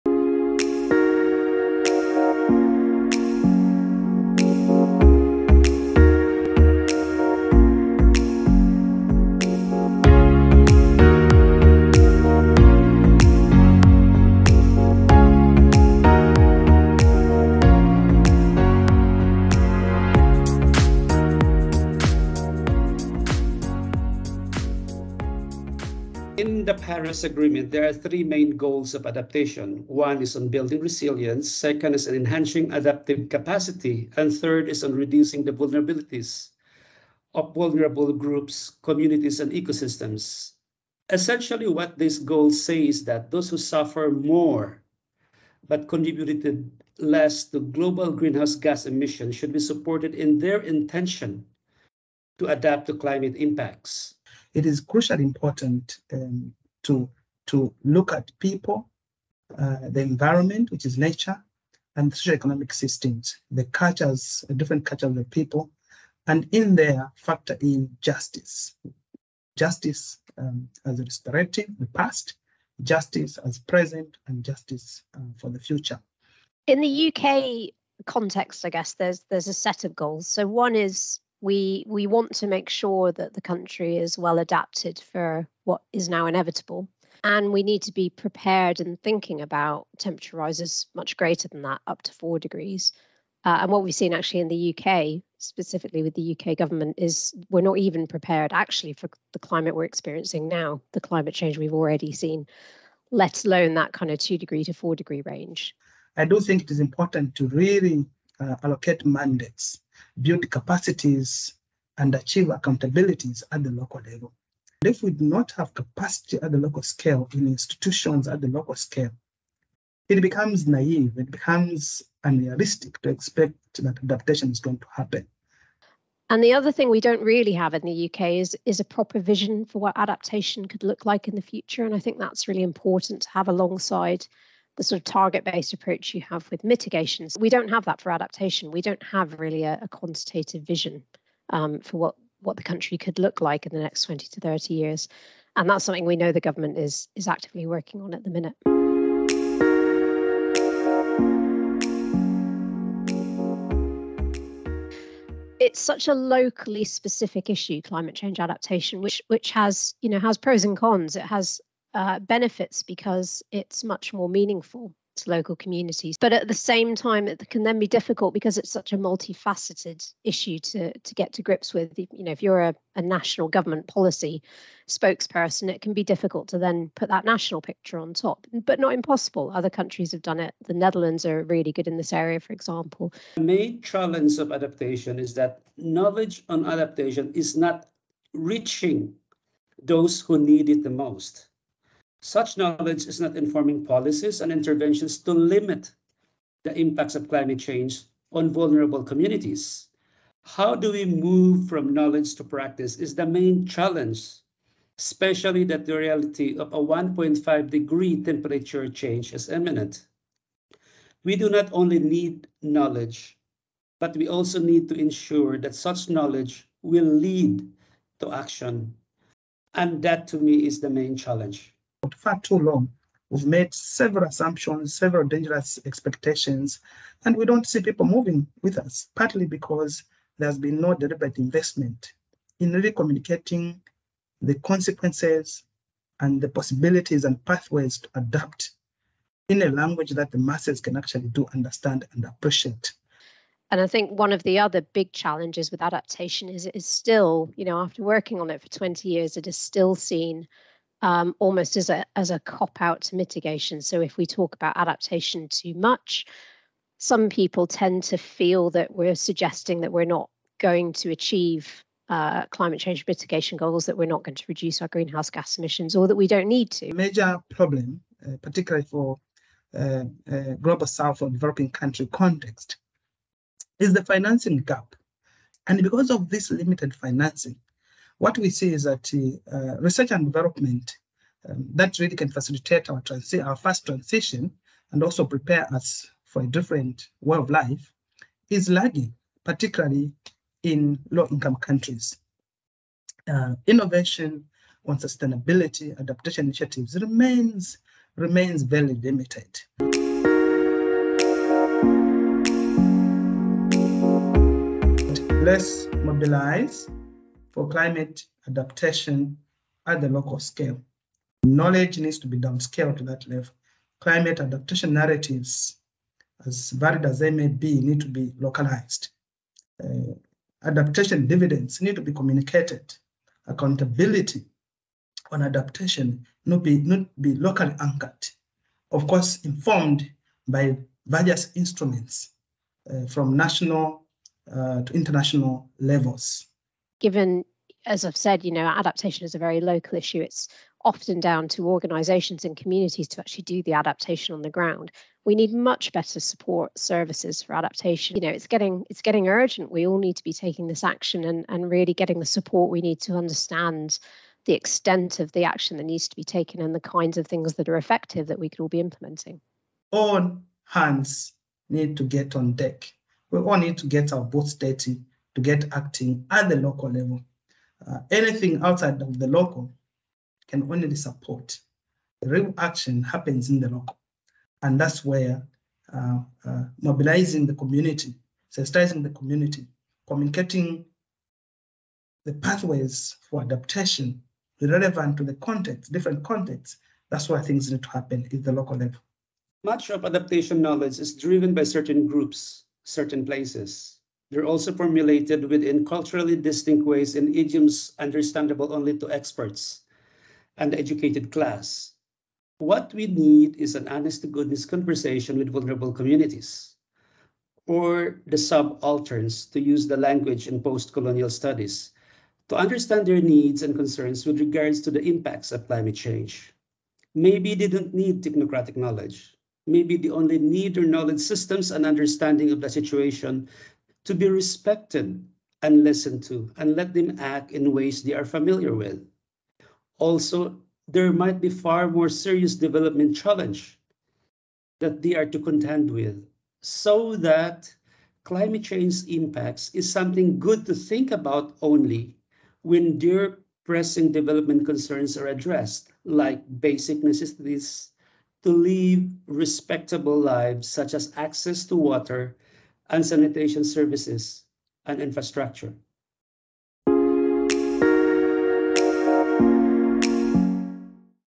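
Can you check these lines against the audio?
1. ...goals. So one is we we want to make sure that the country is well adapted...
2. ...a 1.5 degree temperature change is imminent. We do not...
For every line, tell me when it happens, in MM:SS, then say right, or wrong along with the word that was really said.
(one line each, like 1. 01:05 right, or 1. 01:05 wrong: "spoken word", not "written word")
1. 01:19 right
2. 03:26 right.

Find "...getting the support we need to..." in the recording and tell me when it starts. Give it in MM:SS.
05:51.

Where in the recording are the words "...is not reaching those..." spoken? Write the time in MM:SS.
03:07.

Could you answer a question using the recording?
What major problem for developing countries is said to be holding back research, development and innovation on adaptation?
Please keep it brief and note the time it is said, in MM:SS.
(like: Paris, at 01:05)
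The financing gap, at 04:34.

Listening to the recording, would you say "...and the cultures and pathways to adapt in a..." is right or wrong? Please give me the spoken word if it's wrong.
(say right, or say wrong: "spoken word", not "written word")
wrong: "possibilities", not "cultures".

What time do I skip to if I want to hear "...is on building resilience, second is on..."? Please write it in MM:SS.
00:30.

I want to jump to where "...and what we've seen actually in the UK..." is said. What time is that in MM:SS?
01:33.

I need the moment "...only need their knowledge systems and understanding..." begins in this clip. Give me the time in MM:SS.
07:00.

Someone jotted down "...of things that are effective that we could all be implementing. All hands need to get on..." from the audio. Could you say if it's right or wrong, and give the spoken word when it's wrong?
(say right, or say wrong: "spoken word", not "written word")
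right.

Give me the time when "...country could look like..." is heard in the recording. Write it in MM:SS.
02:22.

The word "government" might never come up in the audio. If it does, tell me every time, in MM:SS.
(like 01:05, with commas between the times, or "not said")
01:36, 02:26, 02:53.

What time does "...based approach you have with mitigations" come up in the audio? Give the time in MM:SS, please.
02:15.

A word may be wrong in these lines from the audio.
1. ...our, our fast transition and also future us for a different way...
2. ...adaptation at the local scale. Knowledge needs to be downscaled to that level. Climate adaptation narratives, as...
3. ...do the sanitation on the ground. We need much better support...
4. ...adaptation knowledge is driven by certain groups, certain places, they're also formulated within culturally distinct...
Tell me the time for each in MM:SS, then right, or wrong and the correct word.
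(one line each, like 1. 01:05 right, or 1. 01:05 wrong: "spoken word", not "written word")
1. 04:42 wrong: "prepare", not "future"
2. 05:08 right
3. 05:43 wrong: "adaptation", not "sanitation"
4. 06:30 right.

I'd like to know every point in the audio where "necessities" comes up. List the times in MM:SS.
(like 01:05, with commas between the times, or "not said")
07:27.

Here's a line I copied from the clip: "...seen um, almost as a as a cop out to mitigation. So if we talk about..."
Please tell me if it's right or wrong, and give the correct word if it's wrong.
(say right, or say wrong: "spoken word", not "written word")
right.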